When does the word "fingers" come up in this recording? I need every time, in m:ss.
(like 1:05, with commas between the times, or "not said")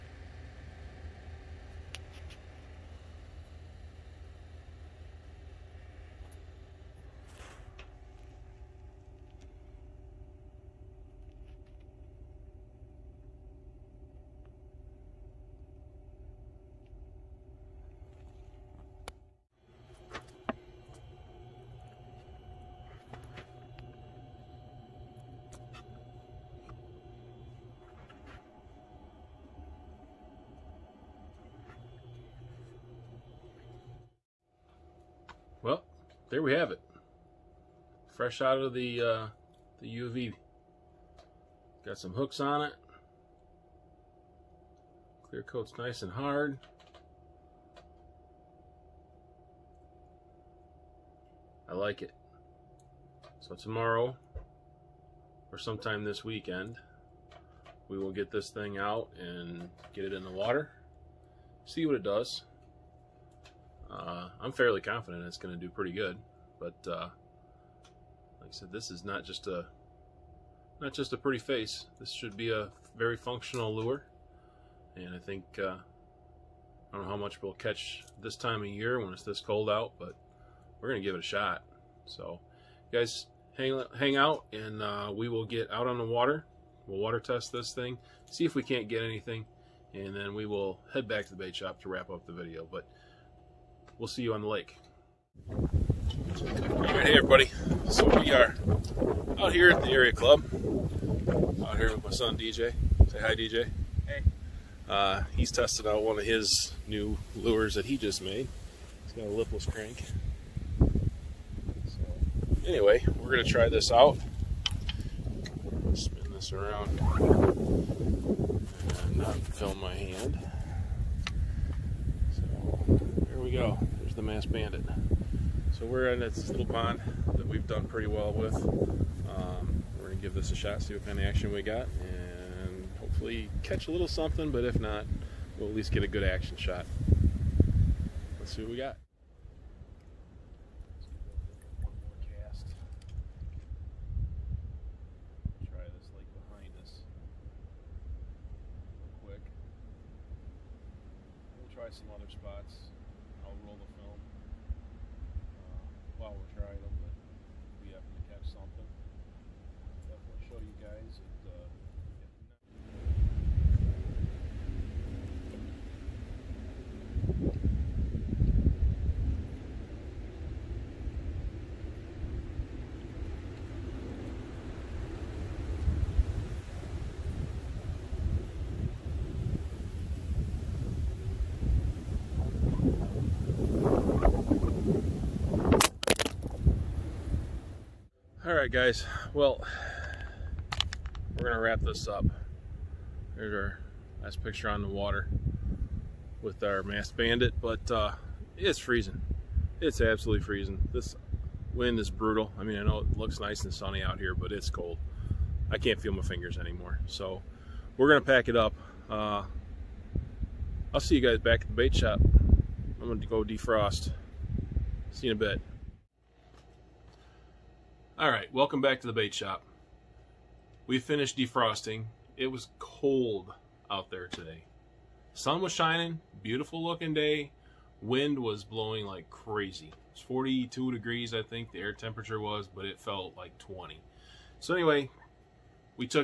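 3:26.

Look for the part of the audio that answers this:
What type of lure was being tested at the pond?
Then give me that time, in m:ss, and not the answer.
1:49.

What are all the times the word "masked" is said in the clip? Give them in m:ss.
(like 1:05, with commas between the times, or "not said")
2:04, 3:16.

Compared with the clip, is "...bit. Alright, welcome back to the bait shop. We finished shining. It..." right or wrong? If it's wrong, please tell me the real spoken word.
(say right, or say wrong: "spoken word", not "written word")
wrong: "defrosting", not "shining".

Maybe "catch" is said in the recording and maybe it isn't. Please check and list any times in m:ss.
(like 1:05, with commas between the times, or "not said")
1:17, 2:13.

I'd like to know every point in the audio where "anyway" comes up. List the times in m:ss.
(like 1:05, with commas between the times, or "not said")
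1:52, 3:54.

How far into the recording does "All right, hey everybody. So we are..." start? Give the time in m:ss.
1:35.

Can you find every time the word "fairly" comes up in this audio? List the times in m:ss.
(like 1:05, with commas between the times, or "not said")
1:04.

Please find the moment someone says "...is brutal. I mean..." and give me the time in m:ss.
3:21.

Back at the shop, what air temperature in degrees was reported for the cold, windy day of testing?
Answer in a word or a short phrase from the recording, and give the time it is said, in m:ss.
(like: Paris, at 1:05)
42, at 3:50.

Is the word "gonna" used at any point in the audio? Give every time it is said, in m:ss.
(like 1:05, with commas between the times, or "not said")
1:53, 3:11, 3:28, 3:33.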